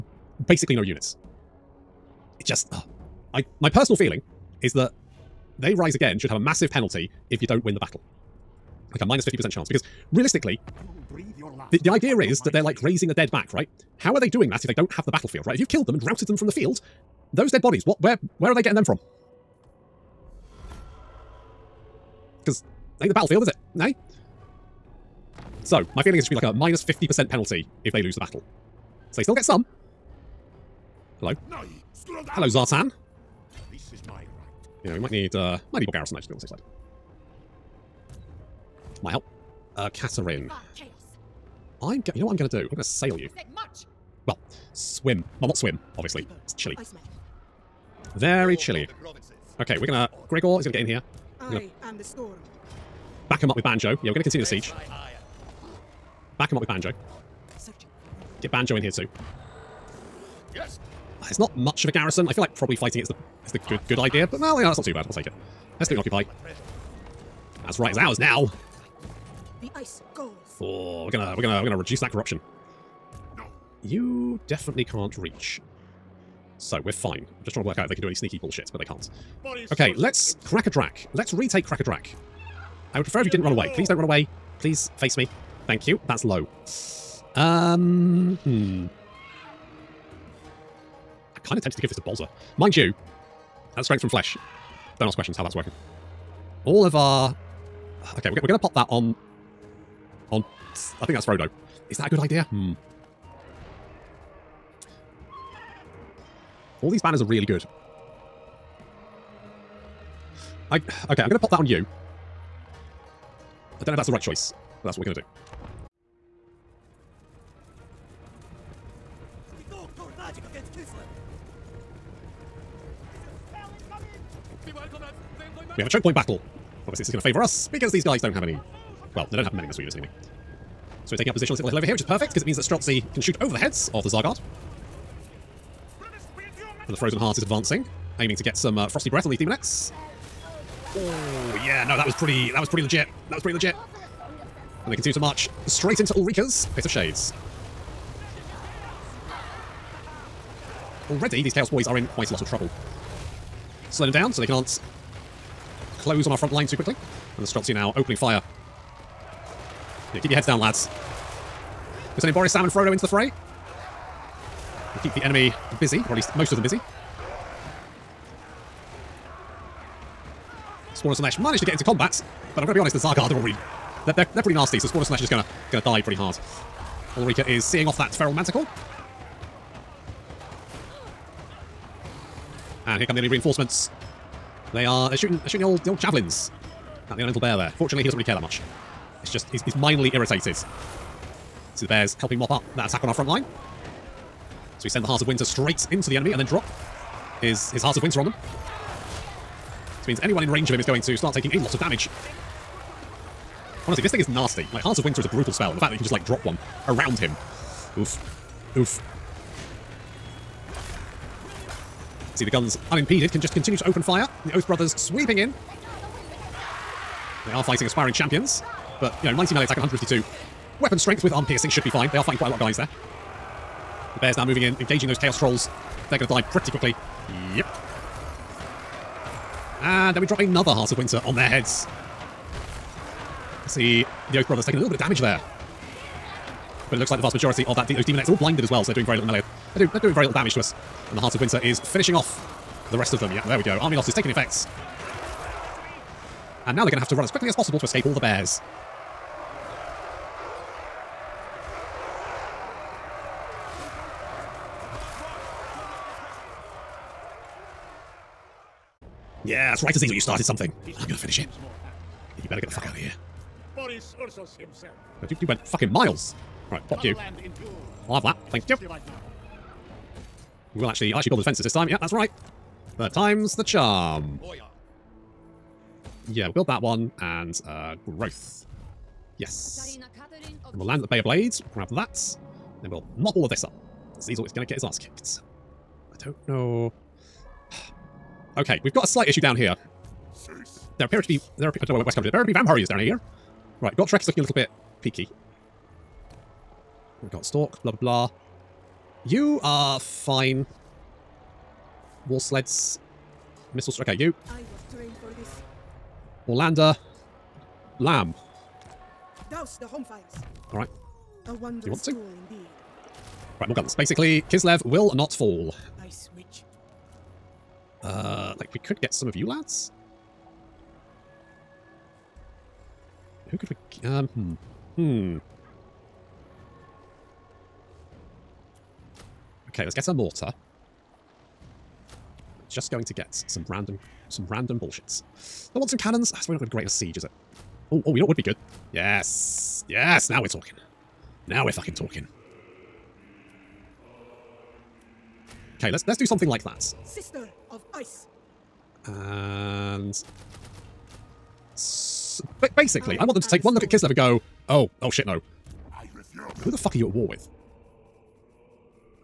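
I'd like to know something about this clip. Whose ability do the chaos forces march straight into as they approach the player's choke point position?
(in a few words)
Pit of Shades.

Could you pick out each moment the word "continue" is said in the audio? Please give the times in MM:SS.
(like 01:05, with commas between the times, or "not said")
00:54, 02:24, 03:33.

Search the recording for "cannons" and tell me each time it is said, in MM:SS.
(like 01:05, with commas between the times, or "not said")
05:35.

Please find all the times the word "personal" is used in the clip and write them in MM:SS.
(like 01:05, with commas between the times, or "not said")
00:03.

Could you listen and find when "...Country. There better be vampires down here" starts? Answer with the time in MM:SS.
04:52.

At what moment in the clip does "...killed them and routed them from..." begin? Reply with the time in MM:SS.
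00:15.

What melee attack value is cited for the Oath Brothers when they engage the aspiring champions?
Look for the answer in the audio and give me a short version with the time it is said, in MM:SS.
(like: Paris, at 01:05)
90, at 03:39.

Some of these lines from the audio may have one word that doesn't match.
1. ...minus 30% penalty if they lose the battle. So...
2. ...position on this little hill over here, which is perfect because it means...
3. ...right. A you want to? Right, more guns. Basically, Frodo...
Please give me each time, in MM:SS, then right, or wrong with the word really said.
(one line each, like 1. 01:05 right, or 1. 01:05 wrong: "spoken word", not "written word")
1. 00:26 wrong: "50", not "30"
2. 02:11 right
3. 05:10 wrong: "Kislev", not "Frodo".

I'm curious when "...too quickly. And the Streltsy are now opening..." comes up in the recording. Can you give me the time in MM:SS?
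02:36.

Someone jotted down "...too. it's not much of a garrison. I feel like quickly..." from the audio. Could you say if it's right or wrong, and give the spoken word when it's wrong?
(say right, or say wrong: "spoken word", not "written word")
wrong: "probably", not "quickly".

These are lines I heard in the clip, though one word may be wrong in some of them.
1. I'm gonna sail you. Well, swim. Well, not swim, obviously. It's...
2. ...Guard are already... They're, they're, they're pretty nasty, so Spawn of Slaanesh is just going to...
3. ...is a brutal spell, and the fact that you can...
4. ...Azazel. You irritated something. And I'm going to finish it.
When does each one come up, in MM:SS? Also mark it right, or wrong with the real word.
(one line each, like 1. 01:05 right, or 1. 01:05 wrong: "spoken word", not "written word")
1. 00:42 right
2. 02:53 right
3. 03:25 right
4. 04:19 wrong: "started", not "irritated".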